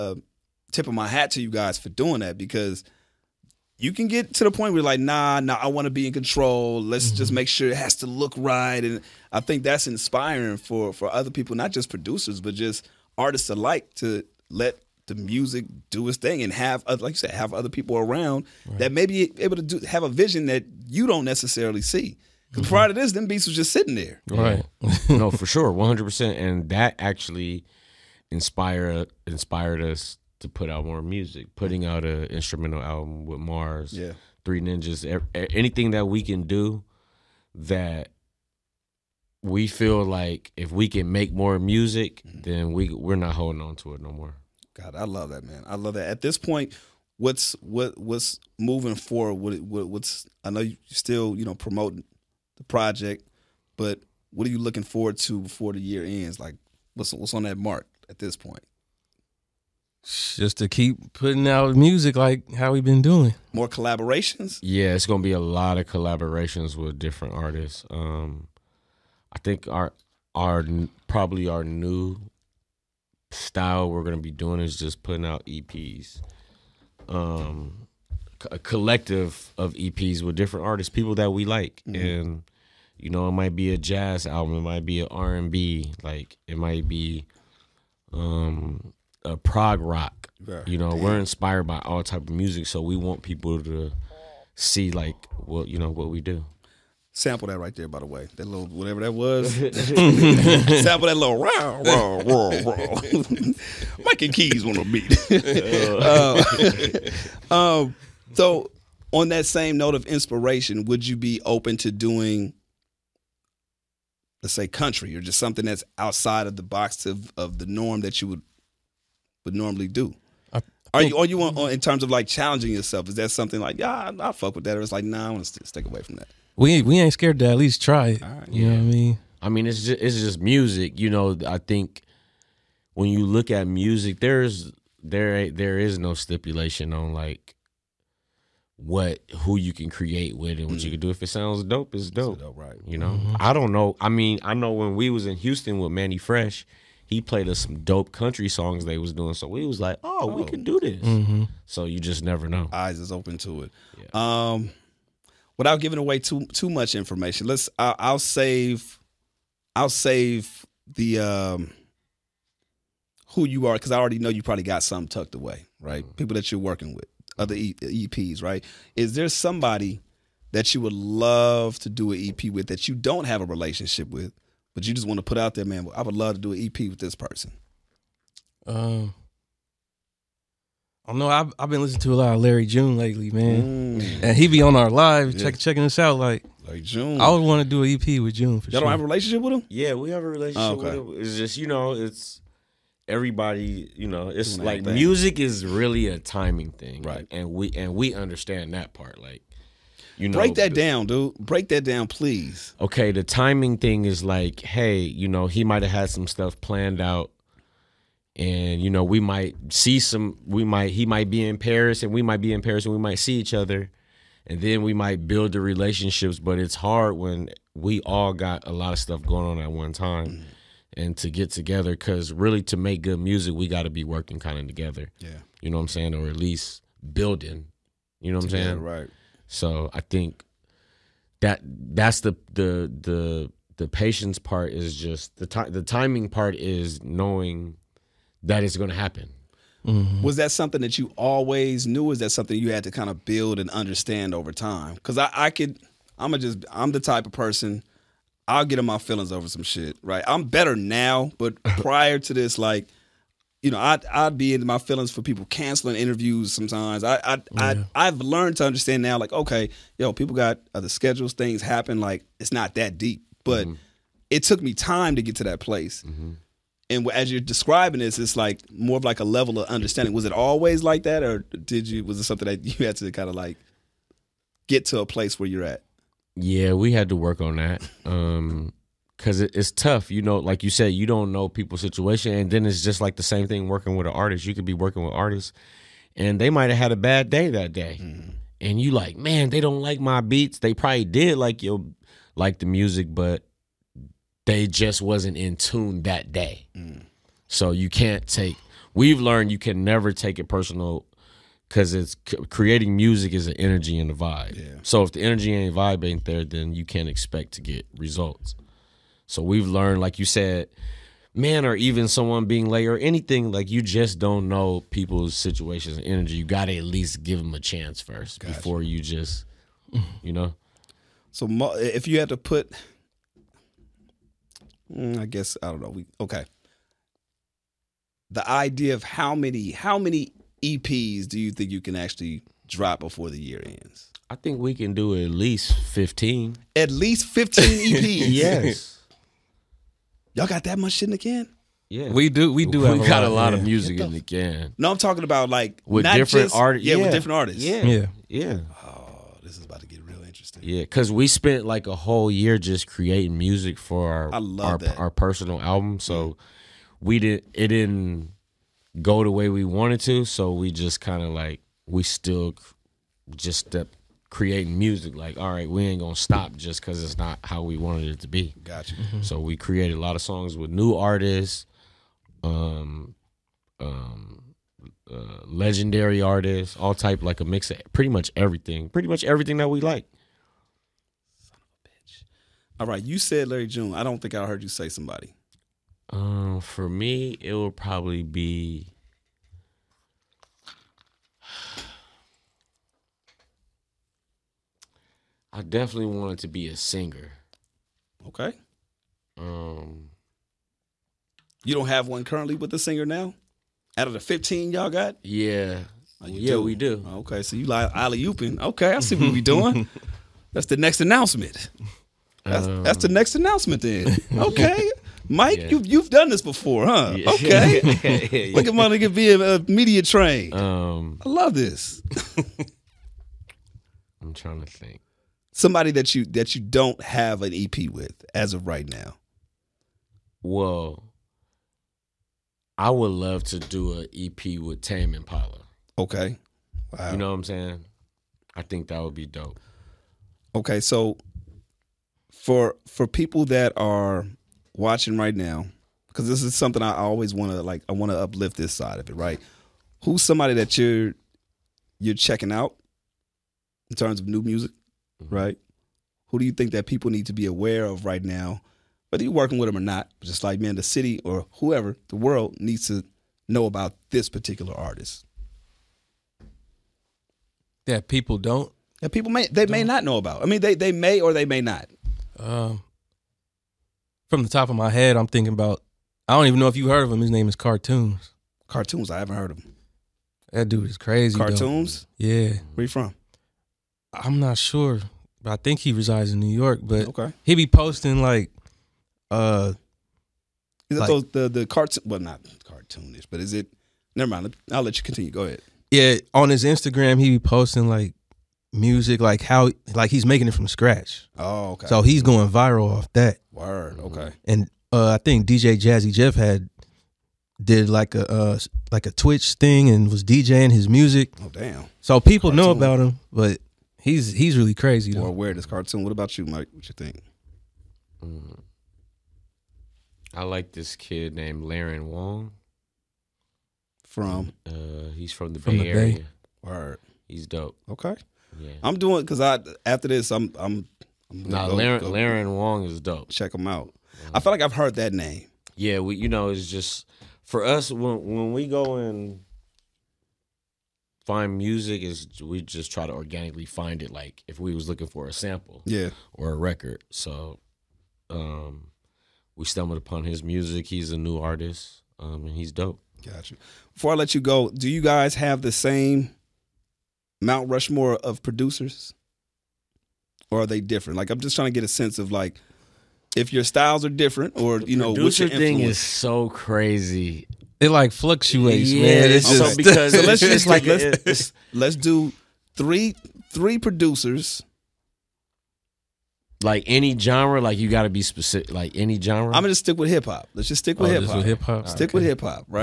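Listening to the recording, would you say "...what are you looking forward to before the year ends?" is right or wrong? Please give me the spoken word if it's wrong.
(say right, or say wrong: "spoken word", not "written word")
right.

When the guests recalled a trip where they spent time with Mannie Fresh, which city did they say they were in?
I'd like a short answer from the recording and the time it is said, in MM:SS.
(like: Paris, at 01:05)
Houston, at 02:25.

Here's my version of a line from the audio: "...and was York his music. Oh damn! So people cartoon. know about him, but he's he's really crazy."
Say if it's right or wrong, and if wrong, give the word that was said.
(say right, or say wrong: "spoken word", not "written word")
wrong: "DJing", not "York".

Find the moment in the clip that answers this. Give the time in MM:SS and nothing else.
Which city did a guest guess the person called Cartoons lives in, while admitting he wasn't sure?
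08:06.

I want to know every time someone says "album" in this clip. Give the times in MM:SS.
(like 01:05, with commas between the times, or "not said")
00:32, 01:24, 05:55.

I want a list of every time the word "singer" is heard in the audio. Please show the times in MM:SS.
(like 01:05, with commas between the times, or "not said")
06:36, 06:42.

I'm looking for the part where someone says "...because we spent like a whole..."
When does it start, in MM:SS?
05:50.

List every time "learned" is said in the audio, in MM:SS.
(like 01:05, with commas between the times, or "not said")
04:18, 04:59, 05:09.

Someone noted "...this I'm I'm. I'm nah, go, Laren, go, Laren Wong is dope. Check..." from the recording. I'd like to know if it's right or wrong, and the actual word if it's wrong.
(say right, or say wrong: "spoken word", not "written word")
right.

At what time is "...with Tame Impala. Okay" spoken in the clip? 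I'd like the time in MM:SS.
07:14.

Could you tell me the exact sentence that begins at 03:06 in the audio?
Like June, I would want to do an EP with June.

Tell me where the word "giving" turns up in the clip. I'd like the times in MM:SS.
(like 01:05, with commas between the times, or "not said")
02:35.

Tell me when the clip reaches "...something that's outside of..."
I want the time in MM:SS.
01:55.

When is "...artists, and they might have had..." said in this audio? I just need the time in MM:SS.
04:45.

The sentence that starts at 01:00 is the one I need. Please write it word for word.
Just to keep putting out music like how we've been doing.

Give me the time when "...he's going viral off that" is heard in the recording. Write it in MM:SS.
08:22.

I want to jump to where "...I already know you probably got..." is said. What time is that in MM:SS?
02:43.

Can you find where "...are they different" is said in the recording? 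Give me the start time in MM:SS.
09:20.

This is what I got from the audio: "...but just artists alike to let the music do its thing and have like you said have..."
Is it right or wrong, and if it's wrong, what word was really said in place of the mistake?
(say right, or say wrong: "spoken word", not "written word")
right.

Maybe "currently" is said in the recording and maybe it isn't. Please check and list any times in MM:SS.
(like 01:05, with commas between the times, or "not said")
06:42.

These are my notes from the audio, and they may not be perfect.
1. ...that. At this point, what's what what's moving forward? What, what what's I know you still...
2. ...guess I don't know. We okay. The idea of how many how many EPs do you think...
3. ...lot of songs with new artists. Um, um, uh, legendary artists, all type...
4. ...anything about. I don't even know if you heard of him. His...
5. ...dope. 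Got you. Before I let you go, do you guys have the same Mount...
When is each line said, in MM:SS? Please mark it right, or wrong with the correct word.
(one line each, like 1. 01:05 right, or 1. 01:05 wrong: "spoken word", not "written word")
1. 00:45 right
2. 05:25 right
3. 06:09 right
4. 07:55 wrong: "thinking", not "anything"
5. 09:12 right.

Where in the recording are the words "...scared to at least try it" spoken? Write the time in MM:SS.
02:07.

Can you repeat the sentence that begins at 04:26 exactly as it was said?
Mm-hmm and as you're describing this, it's like more of like a level of understanding.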